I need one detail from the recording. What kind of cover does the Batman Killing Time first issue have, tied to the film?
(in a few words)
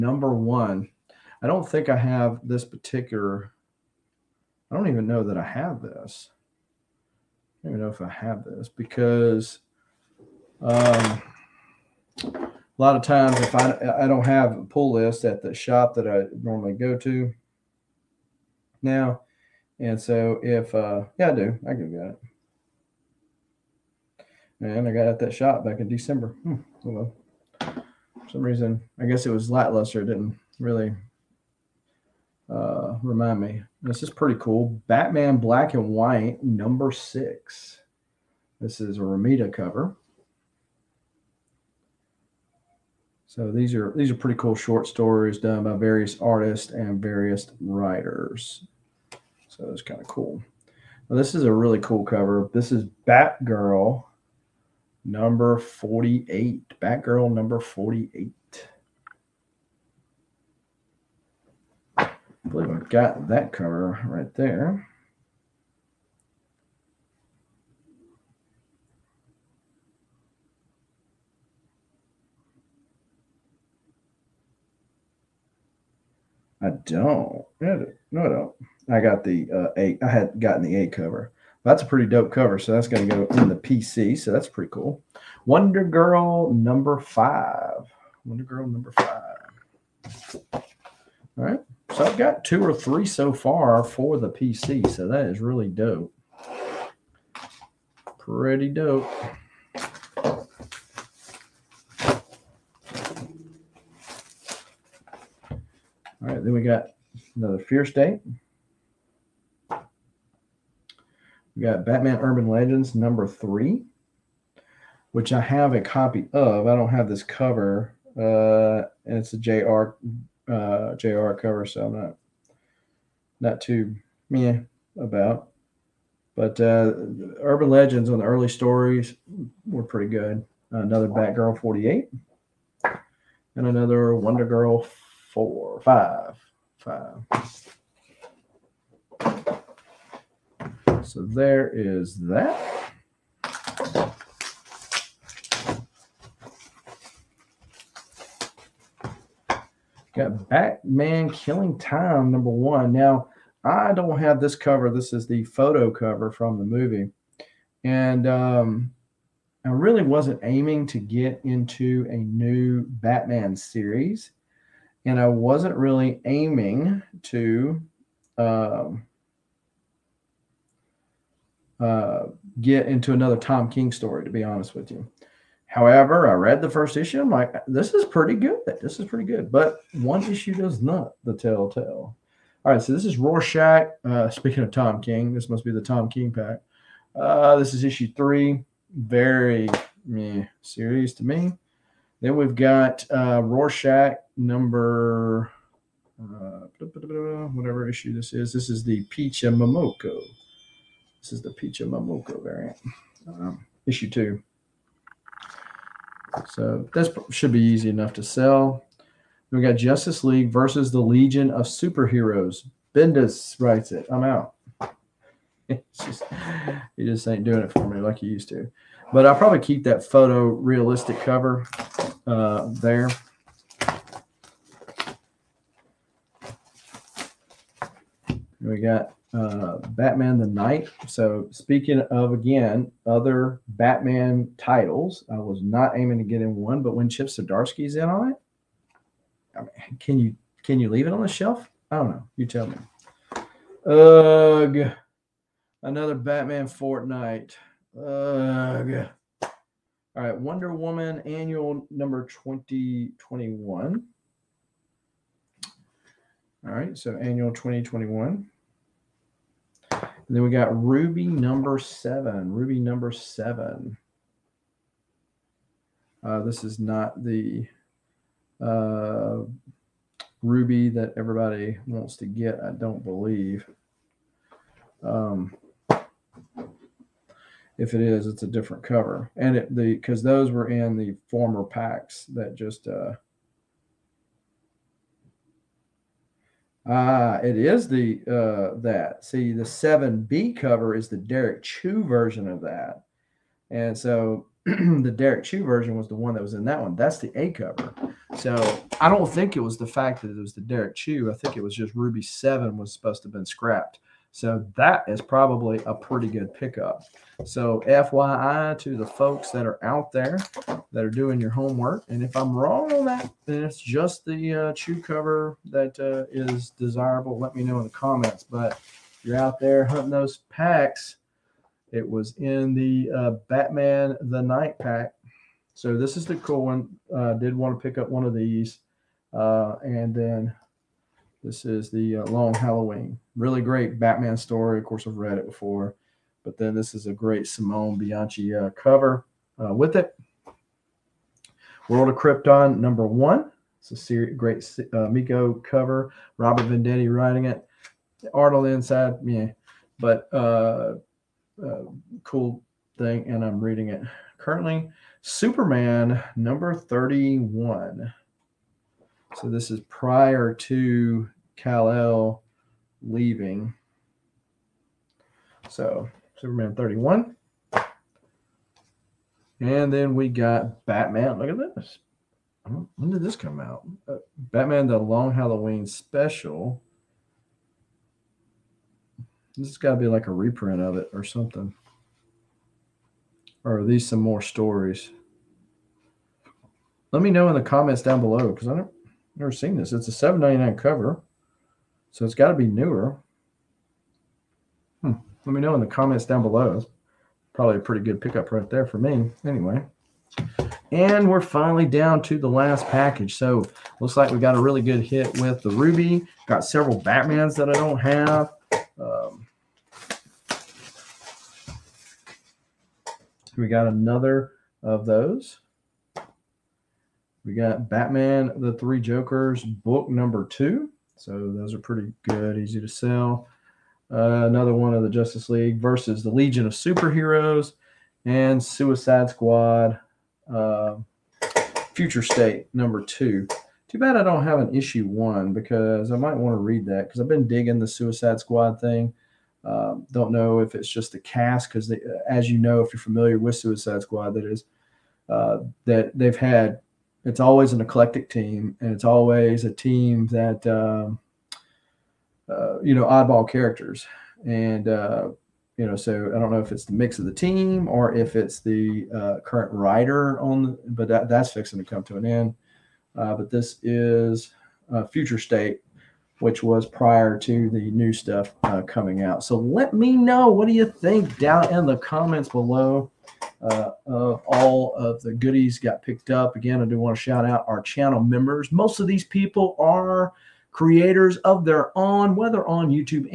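Photo cover.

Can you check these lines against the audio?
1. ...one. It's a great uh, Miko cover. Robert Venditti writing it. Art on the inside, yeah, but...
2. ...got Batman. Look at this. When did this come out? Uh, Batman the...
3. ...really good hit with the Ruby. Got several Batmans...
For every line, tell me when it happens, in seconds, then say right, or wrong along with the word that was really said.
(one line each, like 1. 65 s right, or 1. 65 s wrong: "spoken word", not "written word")
1. 343 s right
2. 370 s right
3. 404 s right.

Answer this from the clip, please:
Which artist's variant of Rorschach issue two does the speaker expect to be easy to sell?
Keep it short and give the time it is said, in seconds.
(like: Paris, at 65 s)
Peach Momoko, at 201 s.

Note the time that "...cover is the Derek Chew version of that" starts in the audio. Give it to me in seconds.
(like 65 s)
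290 s.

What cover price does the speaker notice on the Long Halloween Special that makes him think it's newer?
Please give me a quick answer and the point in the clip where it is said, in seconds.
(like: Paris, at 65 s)
$7.99, at 390 s.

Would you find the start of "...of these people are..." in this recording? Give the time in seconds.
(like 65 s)
478 s.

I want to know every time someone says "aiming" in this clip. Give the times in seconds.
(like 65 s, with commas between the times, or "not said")
160 s, 166 s, 235 s.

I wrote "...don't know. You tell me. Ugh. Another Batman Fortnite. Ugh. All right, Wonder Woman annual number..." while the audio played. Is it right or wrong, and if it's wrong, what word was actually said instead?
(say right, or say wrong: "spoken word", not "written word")
right.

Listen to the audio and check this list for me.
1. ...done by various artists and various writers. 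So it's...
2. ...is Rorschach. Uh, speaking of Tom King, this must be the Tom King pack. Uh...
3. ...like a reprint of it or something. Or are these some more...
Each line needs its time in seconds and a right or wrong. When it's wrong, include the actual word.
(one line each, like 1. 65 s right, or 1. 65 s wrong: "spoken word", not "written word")
1. 45 s right
2. 183 s right
3. 380 s right.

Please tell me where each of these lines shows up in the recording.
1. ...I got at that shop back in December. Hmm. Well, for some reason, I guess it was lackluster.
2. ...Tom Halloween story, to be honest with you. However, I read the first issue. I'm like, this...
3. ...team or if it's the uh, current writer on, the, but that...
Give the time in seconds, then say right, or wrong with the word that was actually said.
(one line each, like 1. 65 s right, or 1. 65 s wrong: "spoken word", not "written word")
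1. 24 s right
2. 173 s wrong: "King", not "Halloween"
3. 457 s right.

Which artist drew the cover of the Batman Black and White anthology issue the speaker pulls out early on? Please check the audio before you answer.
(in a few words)
Romita.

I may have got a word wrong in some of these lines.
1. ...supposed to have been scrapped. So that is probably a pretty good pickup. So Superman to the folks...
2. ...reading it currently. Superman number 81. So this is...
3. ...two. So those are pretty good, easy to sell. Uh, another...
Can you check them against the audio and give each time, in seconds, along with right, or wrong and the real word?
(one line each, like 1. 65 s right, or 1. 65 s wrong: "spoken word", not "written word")
1. 302 s wrong: "FYI", not "Superman"
2. 353 s wrong: "31", not "81"
3. 420 s right.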